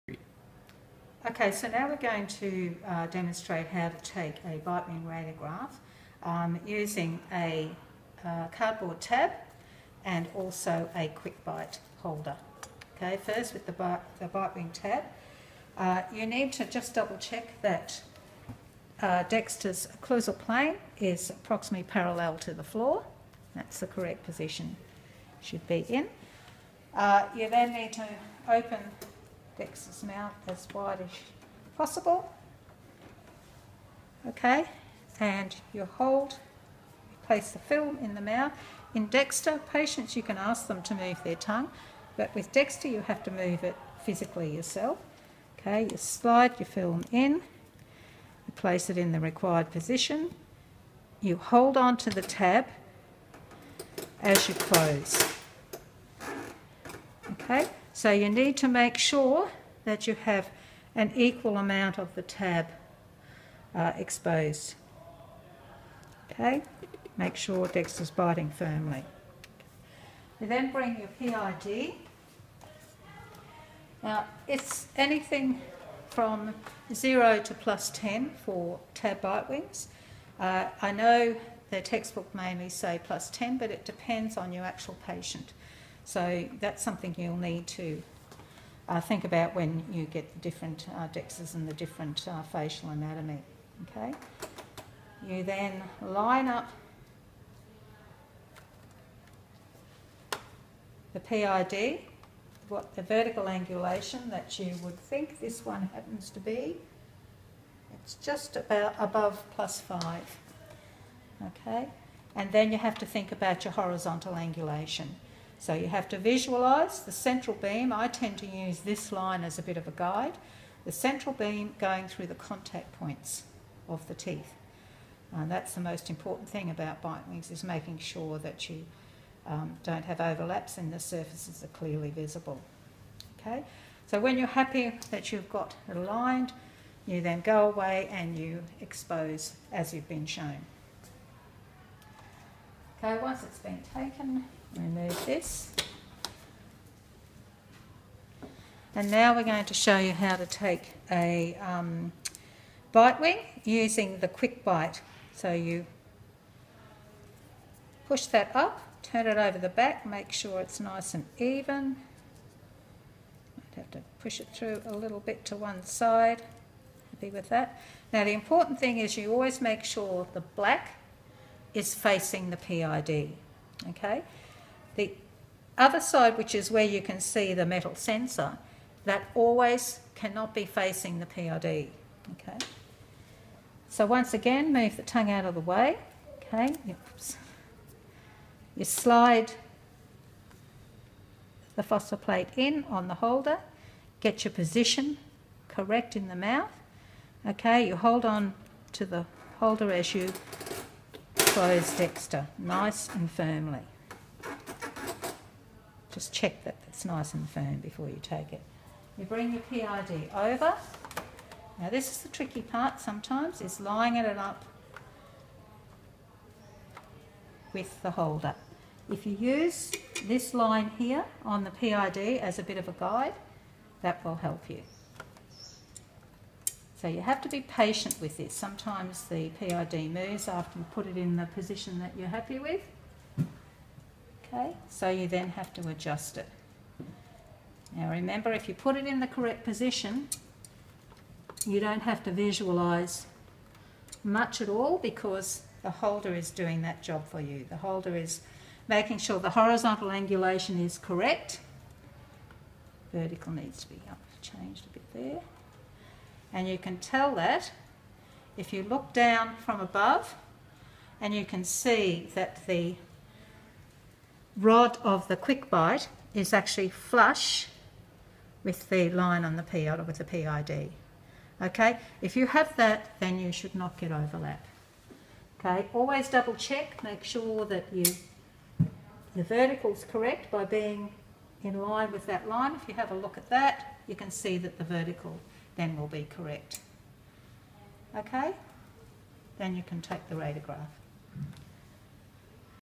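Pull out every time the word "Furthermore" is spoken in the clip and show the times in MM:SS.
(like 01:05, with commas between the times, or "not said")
not said.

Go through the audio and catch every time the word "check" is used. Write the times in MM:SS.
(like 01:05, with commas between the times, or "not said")
00:17, 03:26, 04:36.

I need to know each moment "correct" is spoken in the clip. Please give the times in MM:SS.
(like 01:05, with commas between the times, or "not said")
00:23, 03:15, 03:59, 04:10, 04:40, 04:46.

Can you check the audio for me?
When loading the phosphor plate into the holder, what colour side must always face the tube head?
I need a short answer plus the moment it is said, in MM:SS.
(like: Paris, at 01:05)
Black, at 02:50.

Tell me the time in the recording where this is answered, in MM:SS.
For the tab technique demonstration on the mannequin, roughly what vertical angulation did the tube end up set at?
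01:49.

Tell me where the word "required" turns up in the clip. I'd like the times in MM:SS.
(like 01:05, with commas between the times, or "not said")
00:49.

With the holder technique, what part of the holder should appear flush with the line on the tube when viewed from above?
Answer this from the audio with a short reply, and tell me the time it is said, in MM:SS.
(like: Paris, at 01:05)
The rod, at 04:22.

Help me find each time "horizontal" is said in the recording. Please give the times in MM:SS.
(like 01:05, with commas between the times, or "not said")
01:53, 04:09.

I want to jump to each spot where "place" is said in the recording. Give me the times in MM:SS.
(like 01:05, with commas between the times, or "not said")
00:37, 00:48.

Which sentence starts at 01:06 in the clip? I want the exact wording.
Okay, make sure Dexter's biting firmly.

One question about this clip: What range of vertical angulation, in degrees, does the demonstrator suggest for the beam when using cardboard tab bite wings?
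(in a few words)
0 to +10.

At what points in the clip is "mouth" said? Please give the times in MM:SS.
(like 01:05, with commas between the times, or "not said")
00:30, 00:38, 03:16.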